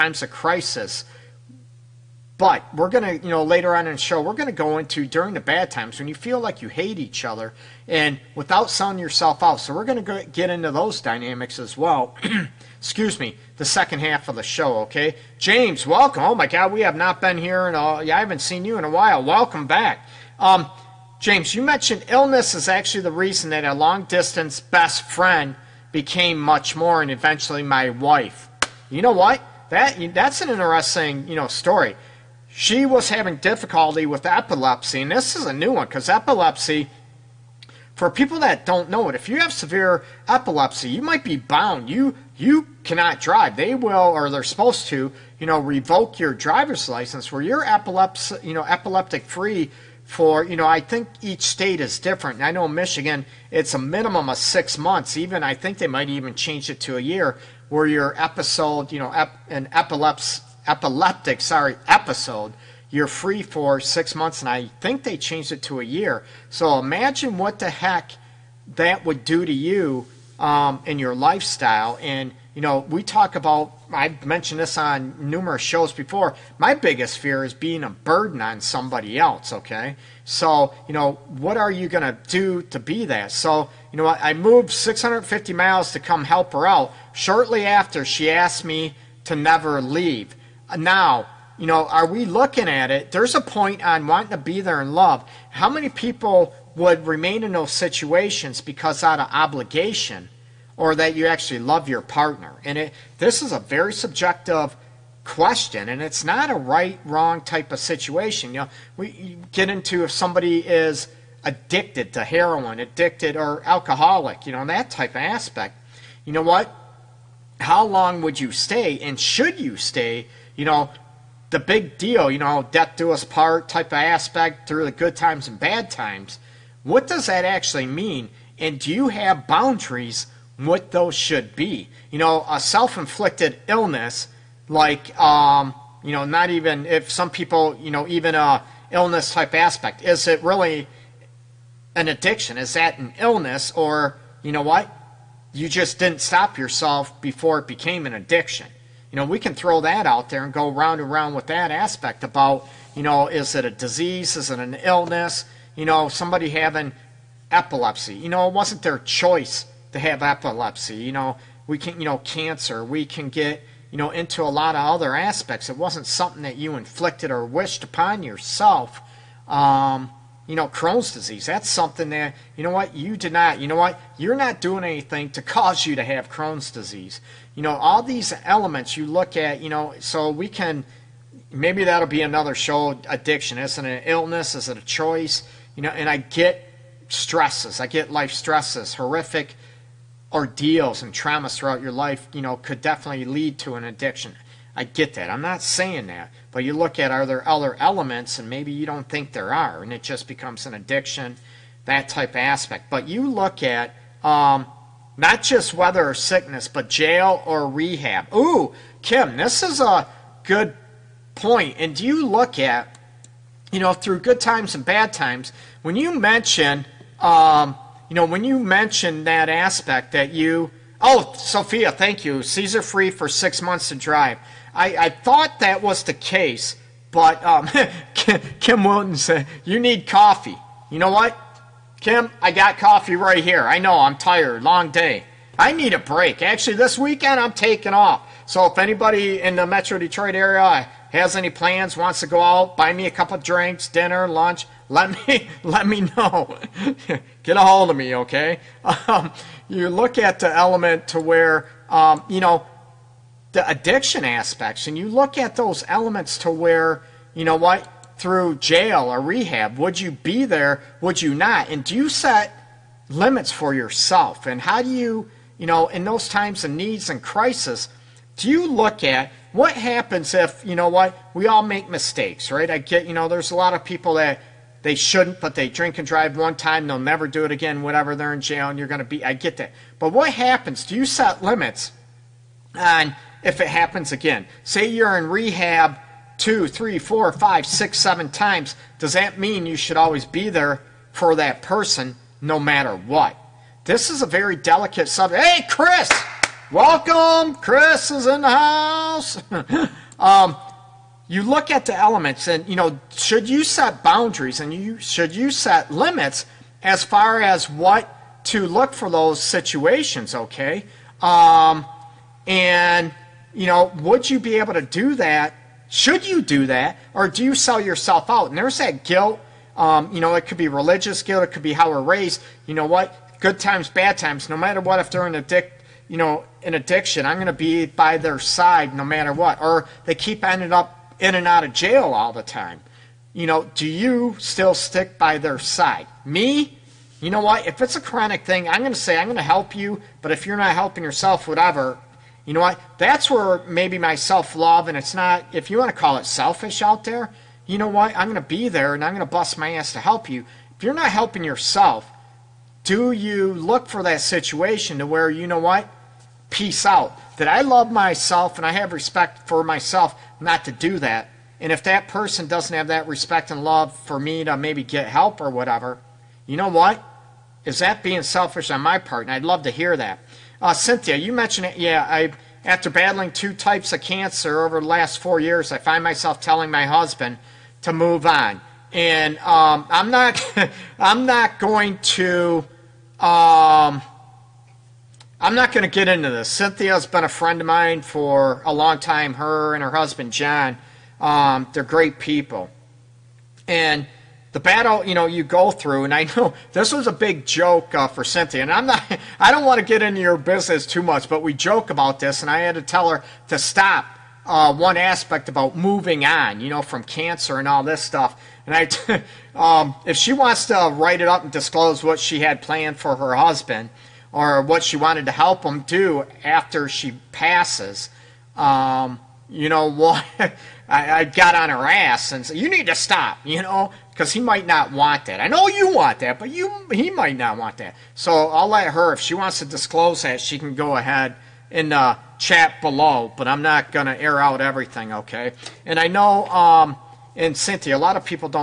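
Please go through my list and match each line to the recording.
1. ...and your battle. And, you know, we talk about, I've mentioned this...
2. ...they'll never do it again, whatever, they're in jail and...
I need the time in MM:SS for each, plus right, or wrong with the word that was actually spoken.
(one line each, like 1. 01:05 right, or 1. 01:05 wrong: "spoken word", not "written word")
1. 01:10 wrong: "lifestyle", not "battle"
2. 04:36 right.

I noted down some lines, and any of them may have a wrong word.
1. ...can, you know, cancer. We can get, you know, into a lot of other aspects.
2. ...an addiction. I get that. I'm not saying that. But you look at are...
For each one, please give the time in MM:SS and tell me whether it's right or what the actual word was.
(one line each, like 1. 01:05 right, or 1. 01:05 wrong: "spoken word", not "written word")
1. 02:41 right
2. 03:13 right.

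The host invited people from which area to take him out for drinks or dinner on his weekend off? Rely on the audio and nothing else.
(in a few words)
Metro Detroit.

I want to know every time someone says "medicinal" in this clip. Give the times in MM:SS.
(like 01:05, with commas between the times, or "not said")
not said.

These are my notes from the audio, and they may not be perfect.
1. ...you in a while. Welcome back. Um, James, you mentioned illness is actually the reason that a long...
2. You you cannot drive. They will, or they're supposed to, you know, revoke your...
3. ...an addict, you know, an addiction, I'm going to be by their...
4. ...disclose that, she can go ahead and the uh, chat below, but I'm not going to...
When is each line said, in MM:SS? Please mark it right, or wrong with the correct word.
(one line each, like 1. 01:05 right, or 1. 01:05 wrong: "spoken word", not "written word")
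1. 00:18 right
2. 00:41 right
3. 05:25 right
4. 07:09 right.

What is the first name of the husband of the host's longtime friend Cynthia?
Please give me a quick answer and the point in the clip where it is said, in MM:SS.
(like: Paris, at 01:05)
John, at 06:30.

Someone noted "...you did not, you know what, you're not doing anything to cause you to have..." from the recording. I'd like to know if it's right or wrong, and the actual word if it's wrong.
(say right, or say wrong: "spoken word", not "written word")
right.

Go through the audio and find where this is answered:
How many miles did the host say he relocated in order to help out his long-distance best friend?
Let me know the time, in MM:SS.
01:24.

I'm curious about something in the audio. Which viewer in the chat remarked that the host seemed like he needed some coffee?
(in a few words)
Kim Wilton.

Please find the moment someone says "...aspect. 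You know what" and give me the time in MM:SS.
01:55.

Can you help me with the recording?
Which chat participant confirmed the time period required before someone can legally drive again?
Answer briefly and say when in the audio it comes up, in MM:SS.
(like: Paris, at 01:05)
Sophia, at 03:41.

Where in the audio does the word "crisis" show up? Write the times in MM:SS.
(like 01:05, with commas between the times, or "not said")
00:00, 04:27.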